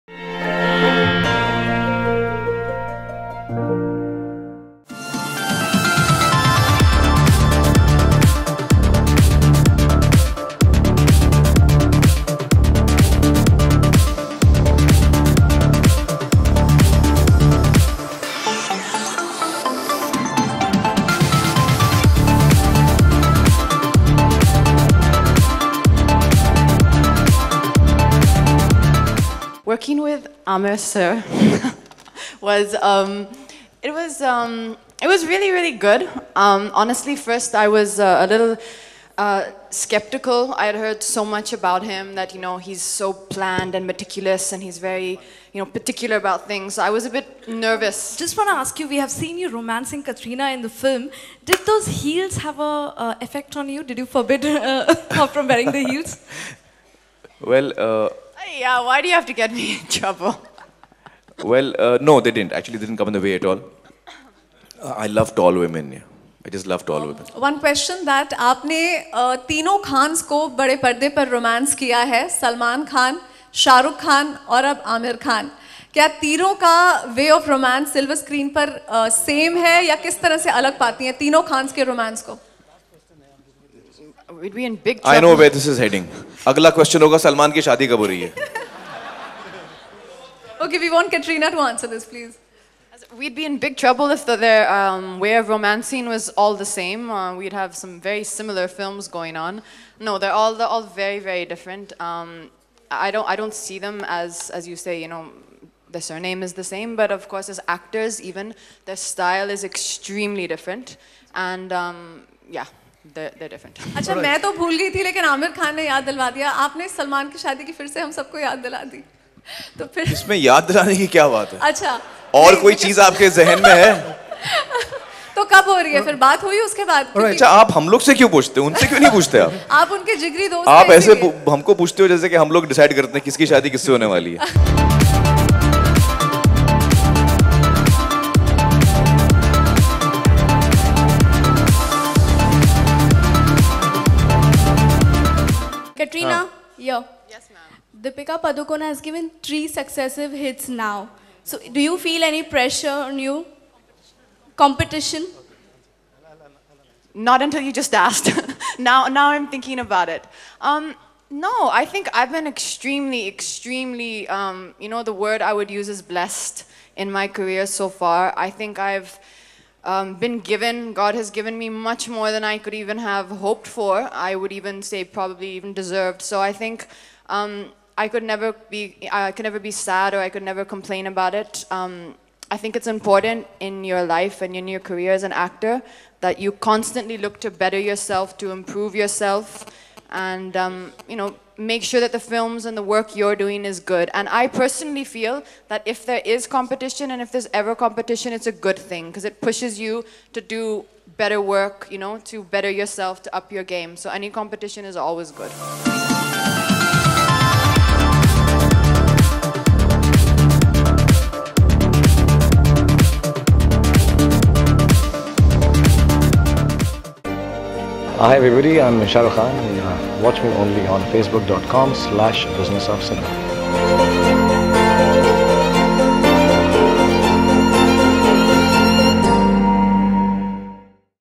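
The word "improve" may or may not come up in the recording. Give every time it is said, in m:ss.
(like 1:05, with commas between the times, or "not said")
3:08.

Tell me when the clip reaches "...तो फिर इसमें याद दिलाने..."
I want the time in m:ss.
1:59.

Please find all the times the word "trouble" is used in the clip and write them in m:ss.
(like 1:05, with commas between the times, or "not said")
0:59, 1:33.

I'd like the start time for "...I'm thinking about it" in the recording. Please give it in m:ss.
2:39.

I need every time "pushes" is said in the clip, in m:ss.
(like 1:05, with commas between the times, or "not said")
3:19.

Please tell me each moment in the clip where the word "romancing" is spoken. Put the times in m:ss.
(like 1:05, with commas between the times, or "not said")
0:49, 1:35.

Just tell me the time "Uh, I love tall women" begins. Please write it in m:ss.
1:04.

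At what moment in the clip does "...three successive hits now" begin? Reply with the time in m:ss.
2:29.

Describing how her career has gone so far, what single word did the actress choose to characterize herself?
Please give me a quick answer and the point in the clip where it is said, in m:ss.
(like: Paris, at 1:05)
blessed, at 2:46.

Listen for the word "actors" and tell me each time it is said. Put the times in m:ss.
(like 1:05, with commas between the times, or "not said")
1:47, 3:05.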